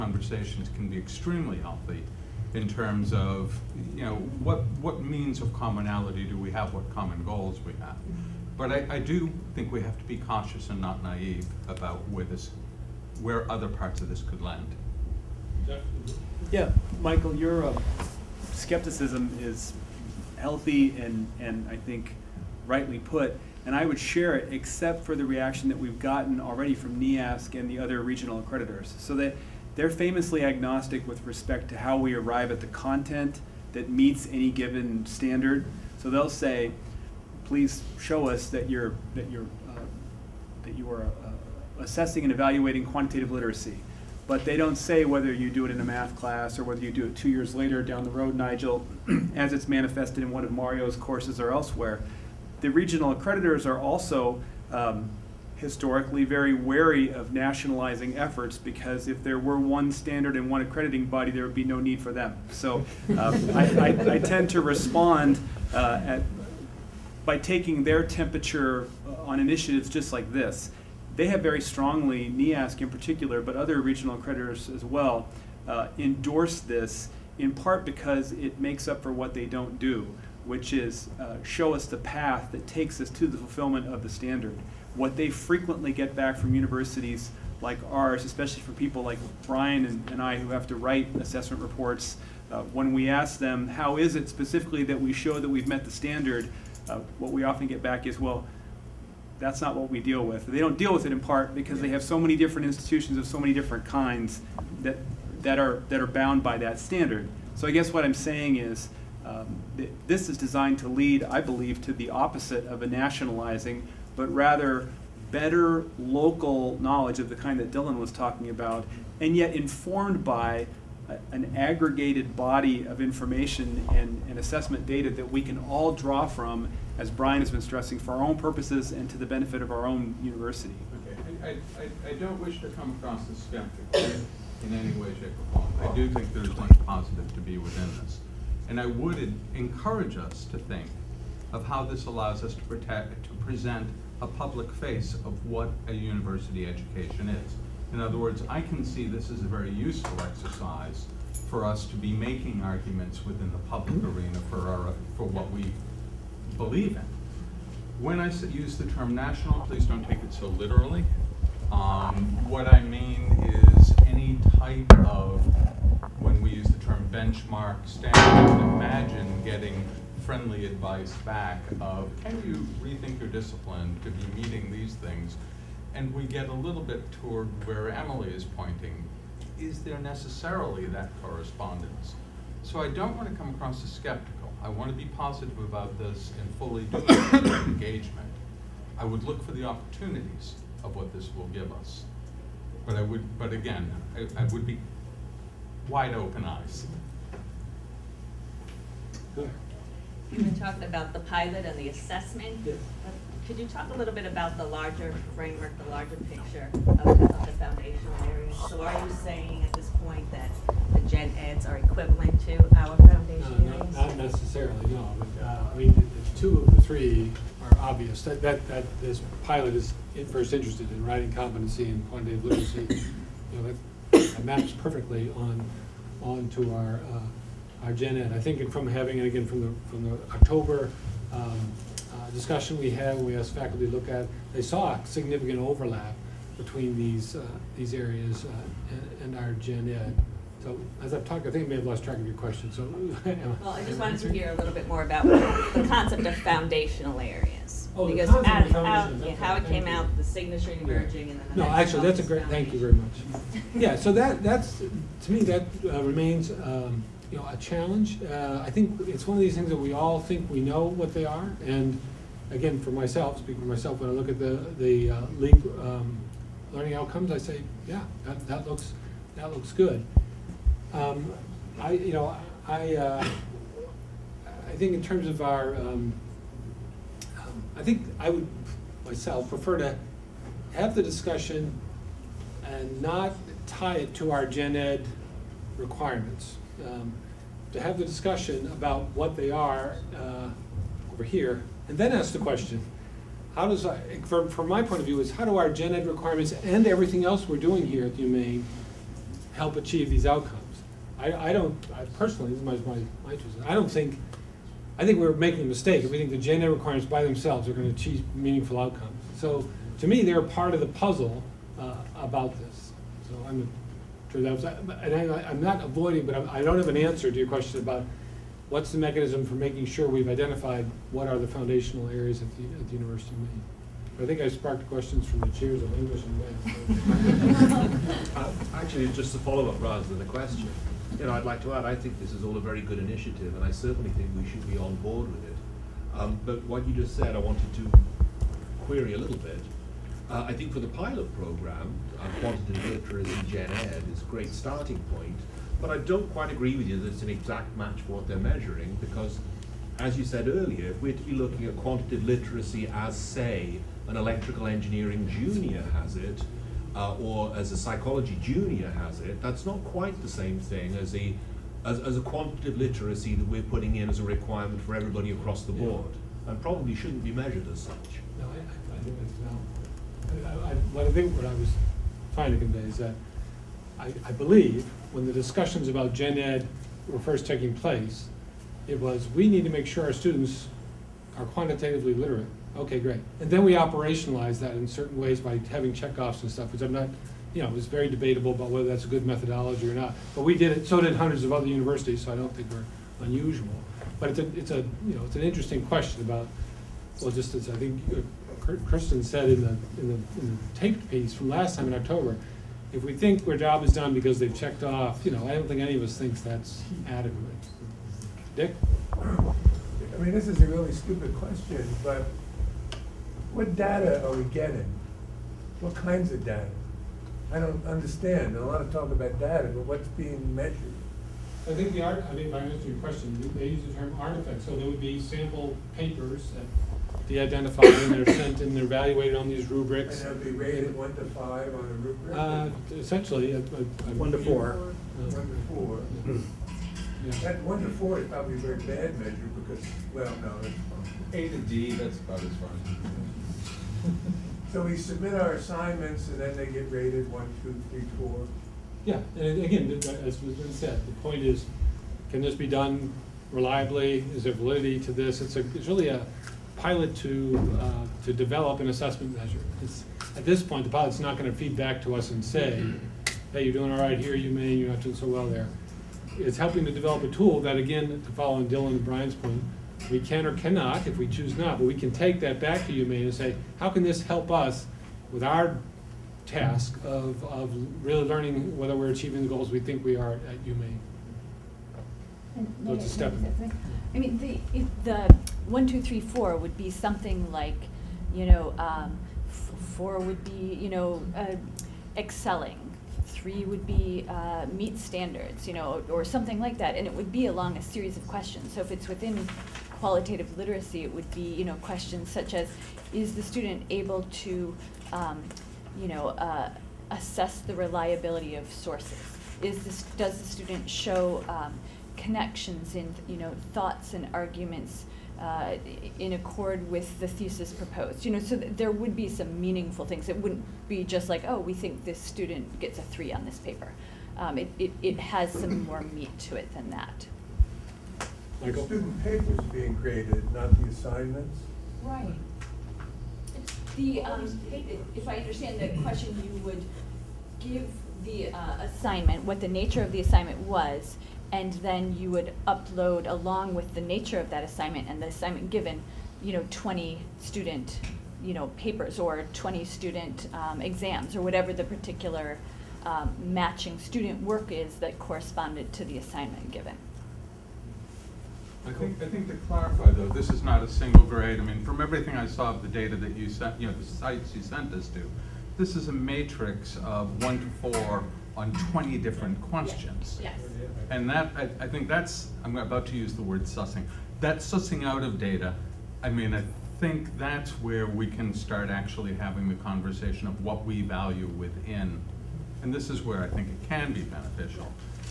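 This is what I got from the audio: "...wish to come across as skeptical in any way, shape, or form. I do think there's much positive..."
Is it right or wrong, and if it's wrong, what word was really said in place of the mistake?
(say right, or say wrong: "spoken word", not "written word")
right.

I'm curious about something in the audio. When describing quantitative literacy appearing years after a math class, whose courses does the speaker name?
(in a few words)
Mario.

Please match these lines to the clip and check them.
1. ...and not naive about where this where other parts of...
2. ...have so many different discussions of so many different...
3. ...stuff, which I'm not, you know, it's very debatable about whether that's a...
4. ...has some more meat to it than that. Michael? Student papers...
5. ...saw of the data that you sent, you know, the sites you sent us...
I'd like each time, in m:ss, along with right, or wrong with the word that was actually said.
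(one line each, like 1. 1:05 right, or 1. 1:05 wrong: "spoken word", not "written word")
1. 0:10 right
2. 1:41 wrong: "institutions", not "discussions"
3. 6:26 right
4. 8:45 right
5. 9:22 right.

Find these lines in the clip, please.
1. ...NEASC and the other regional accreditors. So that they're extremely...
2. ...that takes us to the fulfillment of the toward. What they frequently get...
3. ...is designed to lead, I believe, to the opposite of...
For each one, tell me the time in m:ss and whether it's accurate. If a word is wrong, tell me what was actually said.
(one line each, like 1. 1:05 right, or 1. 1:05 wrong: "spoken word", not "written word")
1. 0:26 wrong: "famously", not "extremely"
2. 1:22 wrong: "standard", not "toward"
3. 1:50 right.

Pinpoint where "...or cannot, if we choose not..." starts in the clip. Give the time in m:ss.
7:50.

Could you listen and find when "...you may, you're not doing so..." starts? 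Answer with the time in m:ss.
7:44.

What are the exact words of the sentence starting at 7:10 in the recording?
And they'll be rated one to five on a rubric?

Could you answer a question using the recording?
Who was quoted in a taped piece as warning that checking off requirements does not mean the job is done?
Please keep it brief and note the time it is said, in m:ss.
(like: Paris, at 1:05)
Kristen, at 6:38.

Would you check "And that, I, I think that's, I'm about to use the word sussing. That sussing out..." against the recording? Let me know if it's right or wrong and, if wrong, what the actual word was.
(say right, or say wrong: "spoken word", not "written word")
right.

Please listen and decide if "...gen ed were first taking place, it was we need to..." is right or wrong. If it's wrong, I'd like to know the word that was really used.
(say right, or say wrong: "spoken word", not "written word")
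right.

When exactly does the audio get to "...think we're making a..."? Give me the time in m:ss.
5:05.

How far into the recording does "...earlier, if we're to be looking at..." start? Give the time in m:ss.
5:50.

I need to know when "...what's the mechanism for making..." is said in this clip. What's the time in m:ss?
5:18.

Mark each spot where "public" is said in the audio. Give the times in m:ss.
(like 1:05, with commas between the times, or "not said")
2:24, 2:33.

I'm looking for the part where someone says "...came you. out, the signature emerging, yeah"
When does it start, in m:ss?
4:09.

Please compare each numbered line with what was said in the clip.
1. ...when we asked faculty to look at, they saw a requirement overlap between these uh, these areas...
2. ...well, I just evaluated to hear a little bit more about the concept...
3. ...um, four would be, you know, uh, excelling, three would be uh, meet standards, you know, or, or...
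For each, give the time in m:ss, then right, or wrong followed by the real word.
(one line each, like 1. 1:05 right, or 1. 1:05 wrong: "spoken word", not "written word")
1. 3:53 wrong: "significant", not "requirement"
2. 4:03 wrong: "wanted", not "evaluated"
3. 8:08 right.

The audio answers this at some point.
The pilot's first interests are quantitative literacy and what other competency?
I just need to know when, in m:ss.
3:41.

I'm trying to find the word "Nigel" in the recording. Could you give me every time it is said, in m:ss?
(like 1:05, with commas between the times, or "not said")
0:48.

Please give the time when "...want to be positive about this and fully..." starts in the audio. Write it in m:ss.
3:04.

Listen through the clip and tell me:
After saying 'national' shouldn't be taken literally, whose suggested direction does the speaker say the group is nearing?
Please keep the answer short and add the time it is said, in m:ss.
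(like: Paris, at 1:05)
Emily, at 2:57.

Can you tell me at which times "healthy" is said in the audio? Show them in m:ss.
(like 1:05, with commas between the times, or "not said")
0:01, 0:20.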